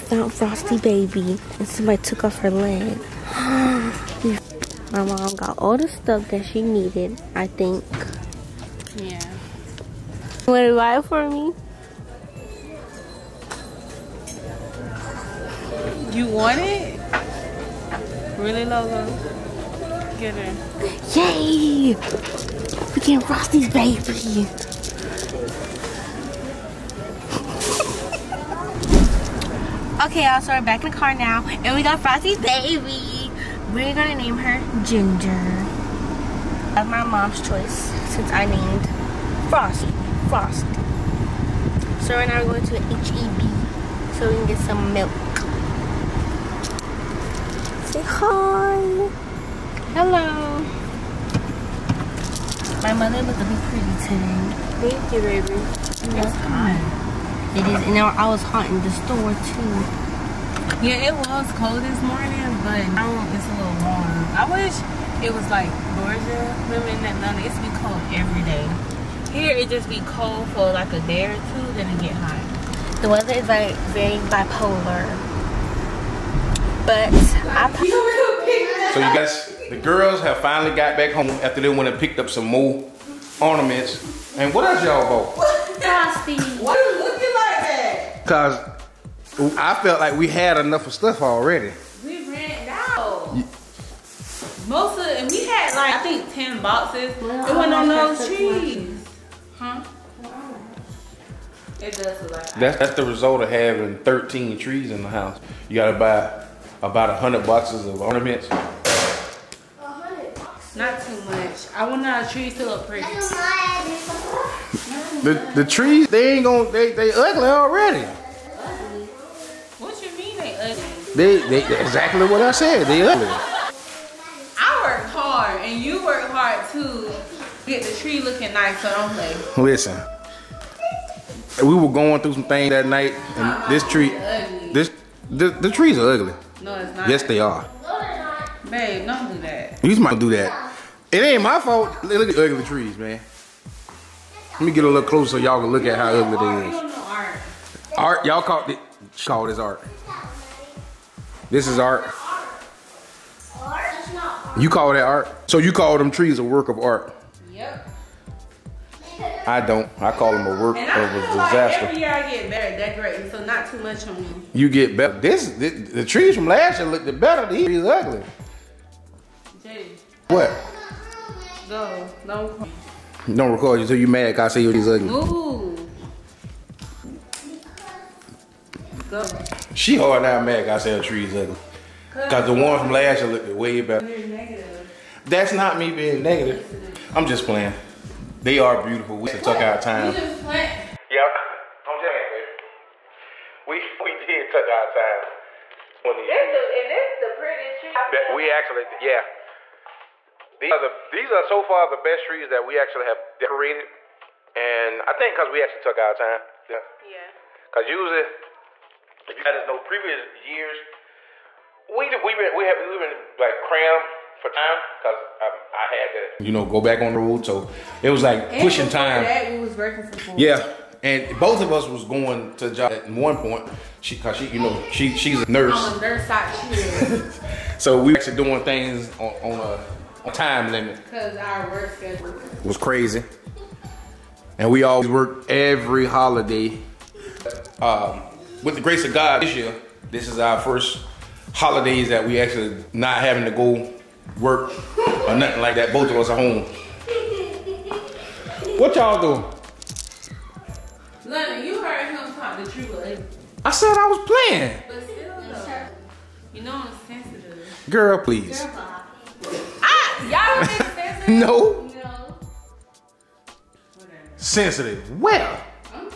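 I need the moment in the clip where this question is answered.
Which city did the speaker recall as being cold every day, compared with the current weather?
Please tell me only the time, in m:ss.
1:07.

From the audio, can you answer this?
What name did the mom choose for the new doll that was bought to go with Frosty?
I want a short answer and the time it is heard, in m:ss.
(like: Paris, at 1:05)
Ginger, at 0:34.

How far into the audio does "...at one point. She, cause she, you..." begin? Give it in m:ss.
3:42.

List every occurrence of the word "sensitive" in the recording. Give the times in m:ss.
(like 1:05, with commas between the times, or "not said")
4:17, 4:24.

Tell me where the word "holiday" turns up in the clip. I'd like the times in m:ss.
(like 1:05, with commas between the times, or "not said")
3:56, 4:01.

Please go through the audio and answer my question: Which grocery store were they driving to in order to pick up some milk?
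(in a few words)
H-E-B.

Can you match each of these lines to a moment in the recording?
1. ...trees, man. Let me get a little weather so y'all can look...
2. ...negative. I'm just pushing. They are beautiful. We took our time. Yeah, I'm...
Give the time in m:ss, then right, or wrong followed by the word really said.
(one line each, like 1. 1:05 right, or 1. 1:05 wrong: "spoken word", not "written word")
1. 2:22 wrong: "closer", not "weather"
2. 3:06 wrong: "playing", not "pushing".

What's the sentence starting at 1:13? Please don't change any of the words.
The weather is like very bipolar.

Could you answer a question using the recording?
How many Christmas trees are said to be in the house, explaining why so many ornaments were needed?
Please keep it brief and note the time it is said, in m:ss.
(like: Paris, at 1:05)
13, at 1:43.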